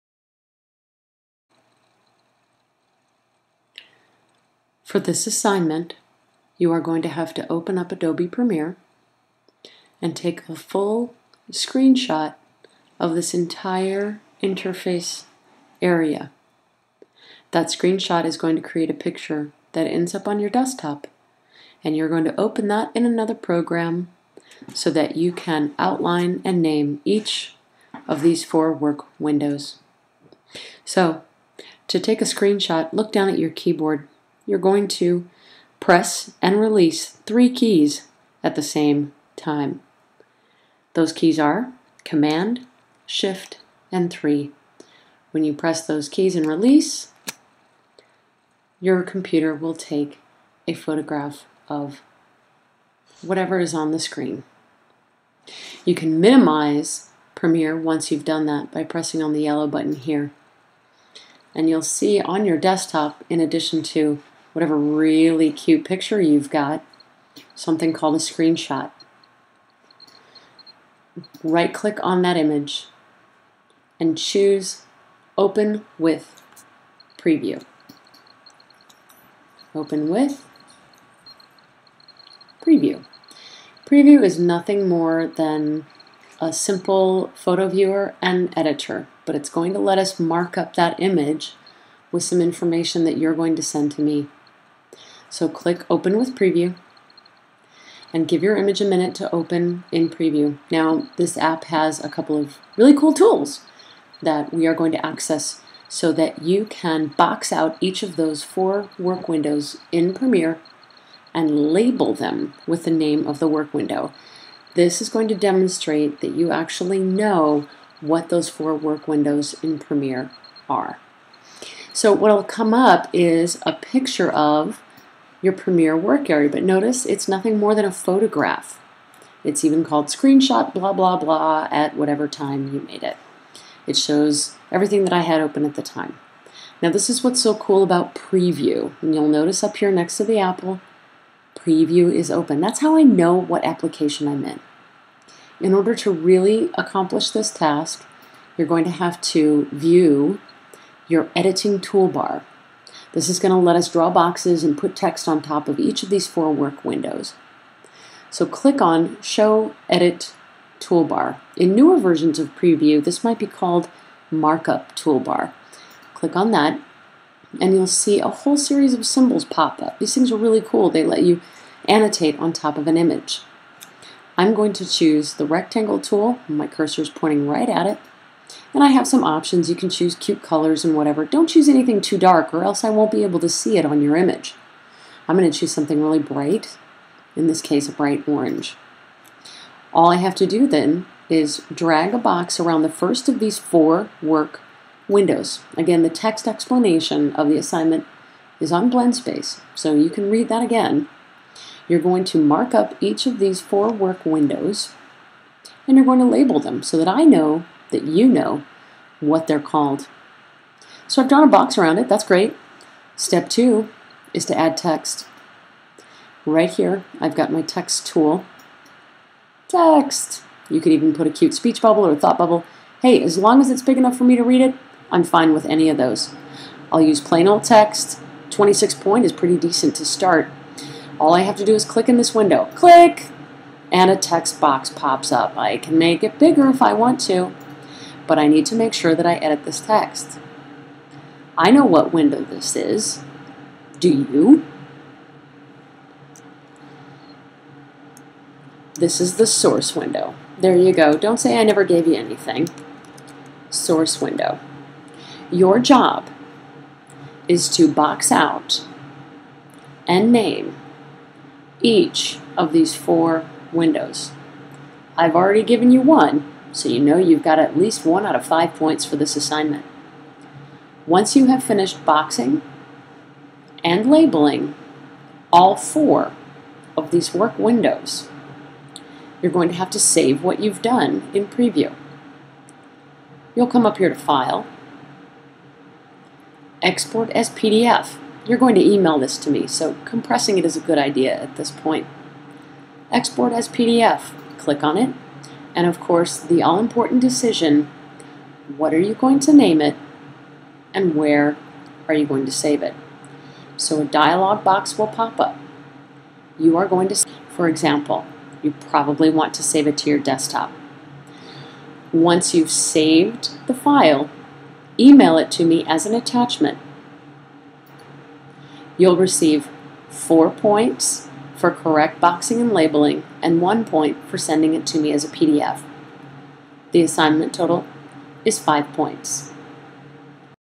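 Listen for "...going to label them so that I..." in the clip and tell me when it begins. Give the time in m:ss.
3:26.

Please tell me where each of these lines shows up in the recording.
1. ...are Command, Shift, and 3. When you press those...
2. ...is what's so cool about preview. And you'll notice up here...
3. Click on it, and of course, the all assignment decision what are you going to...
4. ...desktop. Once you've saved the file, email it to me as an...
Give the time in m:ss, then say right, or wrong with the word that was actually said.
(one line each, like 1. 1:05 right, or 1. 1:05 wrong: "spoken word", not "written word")
1. 0:41 right
2. 2:17 right
3. 4:54 wrong: "important", not "assignment"
4. 5:10 right.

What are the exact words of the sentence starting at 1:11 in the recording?
Right click on that image and choose Open with Preview.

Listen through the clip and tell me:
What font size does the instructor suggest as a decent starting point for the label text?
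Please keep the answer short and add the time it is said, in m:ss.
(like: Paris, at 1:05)
26 point, at 3:48.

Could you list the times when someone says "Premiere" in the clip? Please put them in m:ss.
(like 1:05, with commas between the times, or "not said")
0:08, 0:57, 1:50, 1:59, 2:05.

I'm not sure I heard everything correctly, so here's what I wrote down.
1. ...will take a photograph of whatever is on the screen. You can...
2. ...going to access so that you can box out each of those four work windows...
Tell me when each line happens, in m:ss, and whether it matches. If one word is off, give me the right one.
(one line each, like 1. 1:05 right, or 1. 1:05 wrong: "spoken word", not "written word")
1. 0:49 right
2. 1:44 right.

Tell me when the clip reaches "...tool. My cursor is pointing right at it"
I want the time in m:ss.
2:55.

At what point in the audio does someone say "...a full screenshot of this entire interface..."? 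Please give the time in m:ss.
0:10.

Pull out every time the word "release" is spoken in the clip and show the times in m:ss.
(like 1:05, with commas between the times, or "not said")
0:36, 0:46.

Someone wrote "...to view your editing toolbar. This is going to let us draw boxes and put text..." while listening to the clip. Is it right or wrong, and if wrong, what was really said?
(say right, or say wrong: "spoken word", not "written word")
right.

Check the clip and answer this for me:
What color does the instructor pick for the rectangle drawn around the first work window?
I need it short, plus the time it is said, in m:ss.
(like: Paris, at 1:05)
bright orange, at 3:07.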